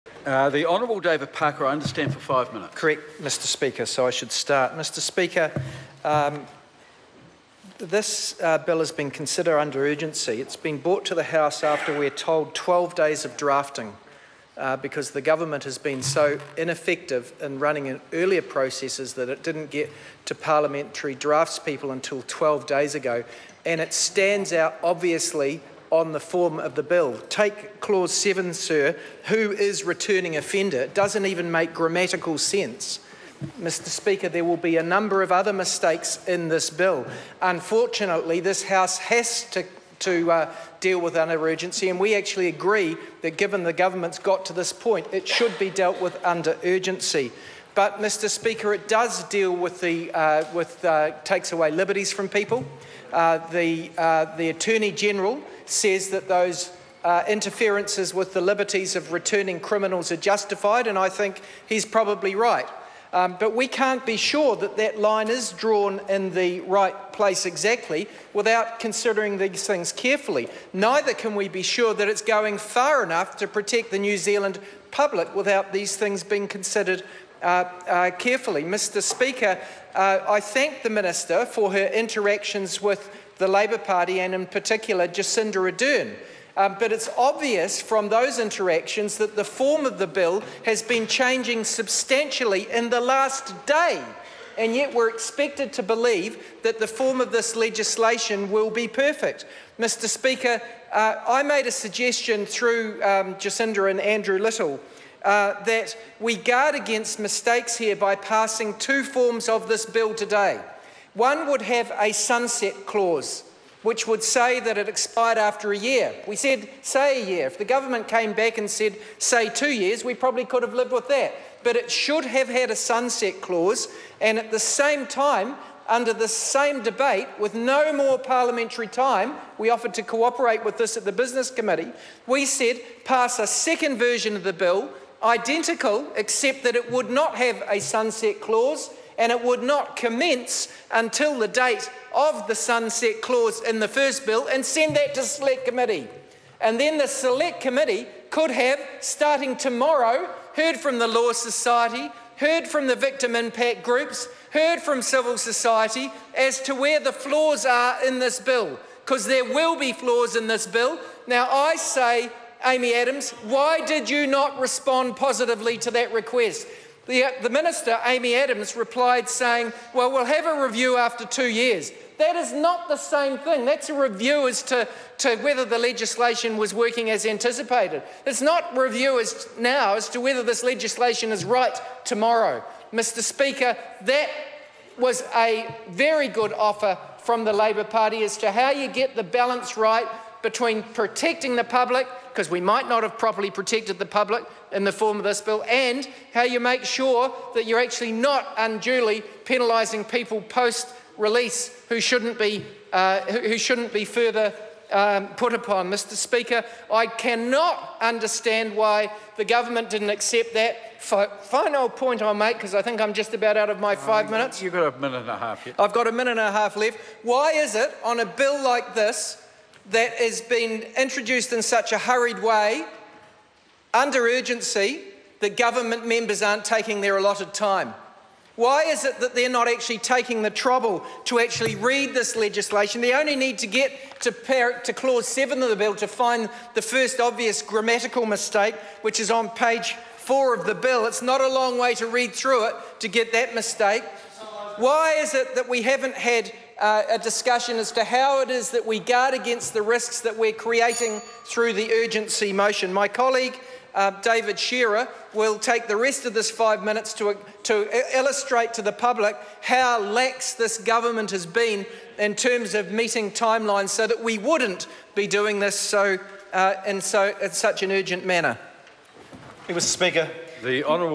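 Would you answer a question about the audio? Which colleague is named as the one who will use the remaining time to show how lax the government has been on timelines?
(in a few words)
David Shearer.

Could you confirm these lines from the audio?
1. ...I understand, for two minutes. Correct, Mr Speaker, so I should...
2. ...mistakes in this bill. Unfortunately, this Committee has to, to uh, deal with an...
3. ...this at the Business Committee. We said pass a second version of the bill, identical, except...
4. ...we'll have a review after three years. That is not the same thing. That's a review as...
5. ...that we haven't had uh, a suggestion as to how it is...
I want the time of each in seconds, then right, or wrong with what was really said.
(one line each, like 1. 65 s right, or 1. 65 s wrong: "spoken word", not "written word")
1. 1 s wrong: "five", not "two"
2. 35 s wrong: "House", not "Committee"
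3. 130 s right
4. 170 s wrong: "two", not "three"
5. 245 s wrong: "discussion", not "suggestion".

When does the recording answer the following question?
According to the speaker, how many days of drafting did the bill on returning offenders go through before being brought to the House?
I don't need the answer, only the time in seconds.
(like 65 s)
12 s.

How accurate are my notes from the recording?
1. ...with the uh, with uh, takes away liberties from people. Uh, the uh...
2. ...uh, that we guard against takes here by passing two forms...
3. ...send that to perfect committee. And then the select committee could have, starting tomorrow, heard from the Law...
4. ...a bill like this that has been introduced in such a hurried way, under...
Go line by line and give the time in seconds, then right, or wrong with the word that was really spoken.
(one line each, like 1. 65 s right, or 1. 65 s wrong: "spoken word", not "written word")
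1. 49 s right
2. 105 s wrong: "mistakes", not "takes"
3. 144 s wrong: "select", not "perfect"
4. 218 s right.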